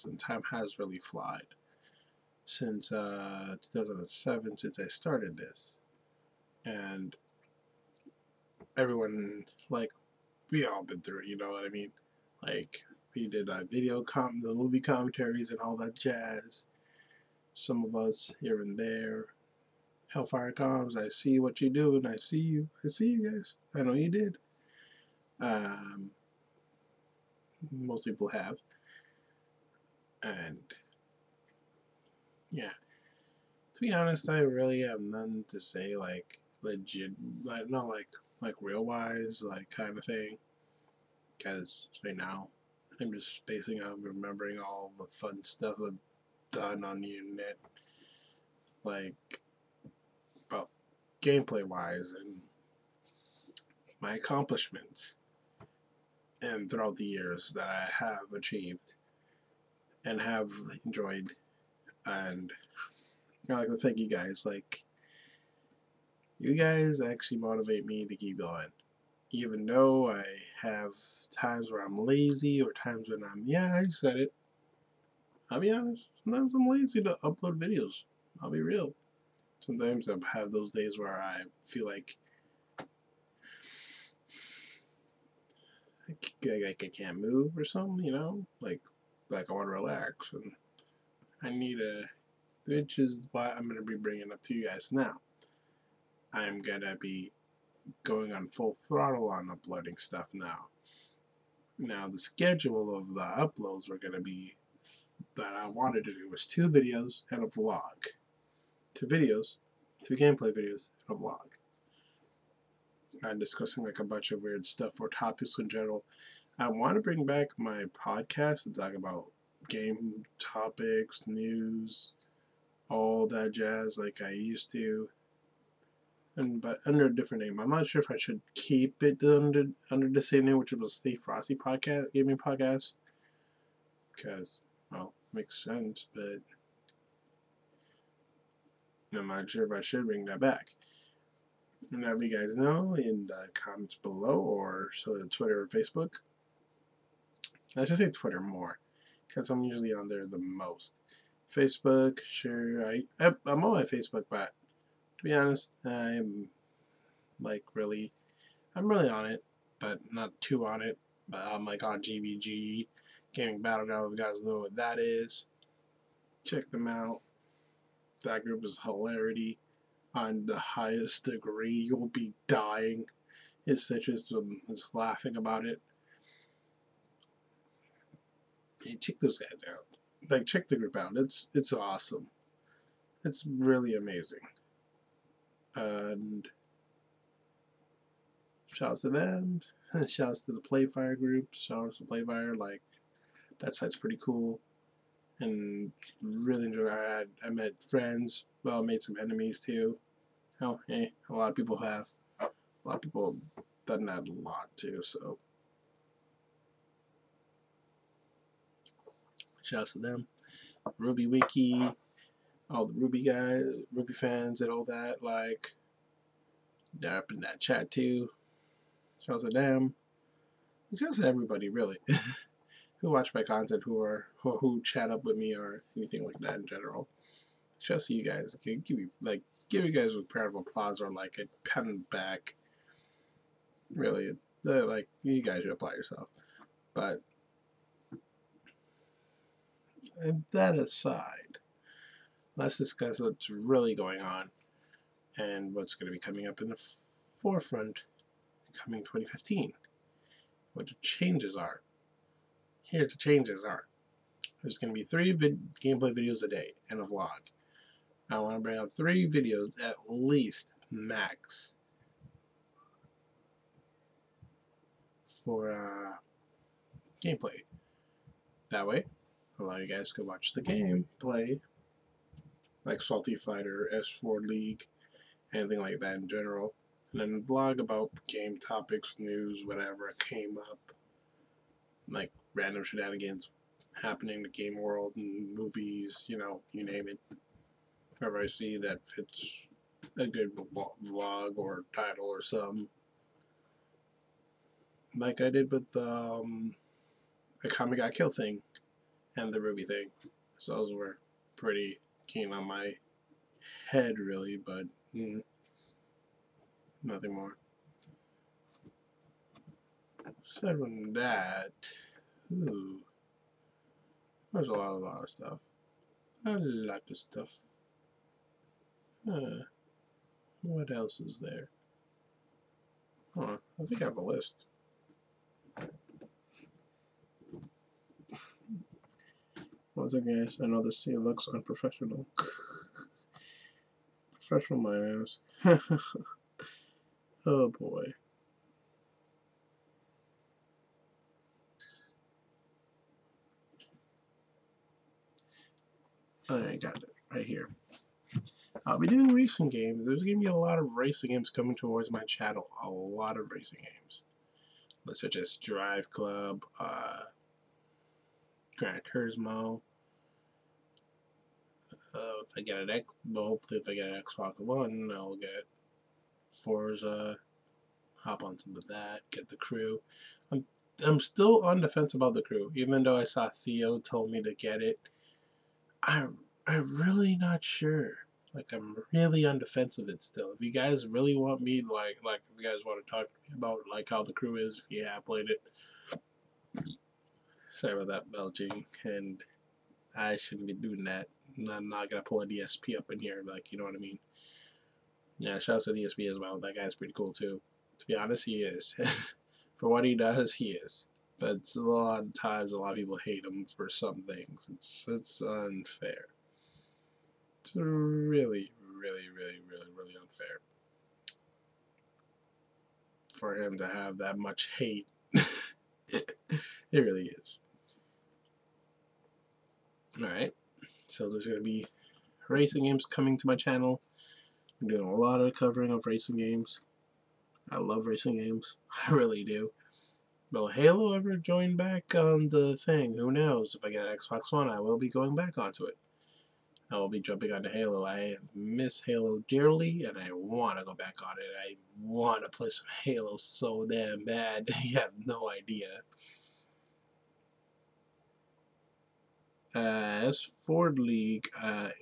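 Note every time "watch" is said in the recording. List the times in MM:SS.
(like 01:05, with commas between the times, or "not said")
03:43, 04:30.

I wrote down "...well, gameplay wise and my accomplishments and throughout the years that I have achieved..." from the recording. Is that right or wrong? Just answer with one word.
right.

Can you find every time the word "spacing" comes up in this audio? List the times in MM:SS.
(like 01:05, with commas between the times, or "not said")
00:43.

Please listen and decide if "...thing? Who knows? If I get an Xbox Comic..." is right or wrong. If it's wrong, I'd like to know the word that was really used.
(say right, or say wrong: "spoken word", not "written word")
wrong: "One", not "Comic".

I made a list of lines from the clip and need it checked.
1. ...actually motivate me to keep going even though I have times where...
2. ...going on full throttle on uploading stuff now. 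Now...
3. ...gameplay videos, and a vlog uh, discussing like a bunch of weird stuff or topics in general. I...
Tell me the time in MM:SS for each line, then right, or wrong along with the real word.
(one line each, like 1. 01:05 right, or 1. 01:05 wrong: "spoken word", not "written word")
1. 01:07 right
2. 01:38 right
3. 01:50 right.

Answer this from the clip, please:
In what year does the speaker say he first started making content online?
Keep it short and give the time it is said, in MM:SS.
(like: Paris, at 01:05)
2007, at 00:03.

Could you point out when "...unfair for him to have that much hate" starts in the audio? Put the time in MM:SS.
06:50.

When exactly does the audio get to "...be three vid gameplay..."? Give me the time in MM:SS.
04:14.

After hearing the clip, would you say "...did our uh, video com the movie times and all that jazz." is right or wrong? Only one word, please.
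wrong.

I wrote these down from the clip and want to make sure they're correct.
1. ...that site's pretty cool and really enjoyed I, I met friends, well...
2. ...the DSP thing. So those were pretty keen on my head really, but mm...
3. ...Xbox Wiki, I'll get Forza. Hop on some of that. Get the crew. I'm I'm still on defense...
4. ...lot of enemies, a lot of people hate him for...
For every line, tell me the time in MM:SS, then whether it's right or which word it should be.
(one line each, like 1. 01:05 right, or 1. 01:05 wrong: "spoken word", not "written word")
1. 03:13 right
2. 04:59 wrong: "RWBY", not "DSP"
3. 06:04 wrong: "One", not "Wiki"
4. 06:41 wrong: "times", not "enemies".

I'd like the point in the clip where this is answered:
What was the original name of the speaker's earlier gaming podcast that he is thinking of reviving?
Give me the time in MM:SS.
02:11.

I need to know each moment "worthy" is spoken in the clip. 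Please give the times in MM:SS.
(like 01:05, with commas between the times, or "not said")
not said.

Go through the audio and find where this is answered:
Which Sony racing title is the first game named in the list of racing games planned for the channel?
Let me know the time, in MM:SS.
05:55.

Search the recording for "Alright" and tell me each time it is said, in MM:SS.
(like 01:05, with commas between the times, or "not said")
07:00.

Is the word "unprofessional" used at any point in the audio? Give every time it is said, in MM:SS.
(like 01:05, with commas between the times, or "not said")
05:31.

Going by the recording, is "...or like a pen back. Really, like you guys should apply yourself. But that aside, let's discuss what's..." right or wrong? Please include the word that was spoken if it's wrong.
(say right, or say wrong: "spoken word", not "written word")
right.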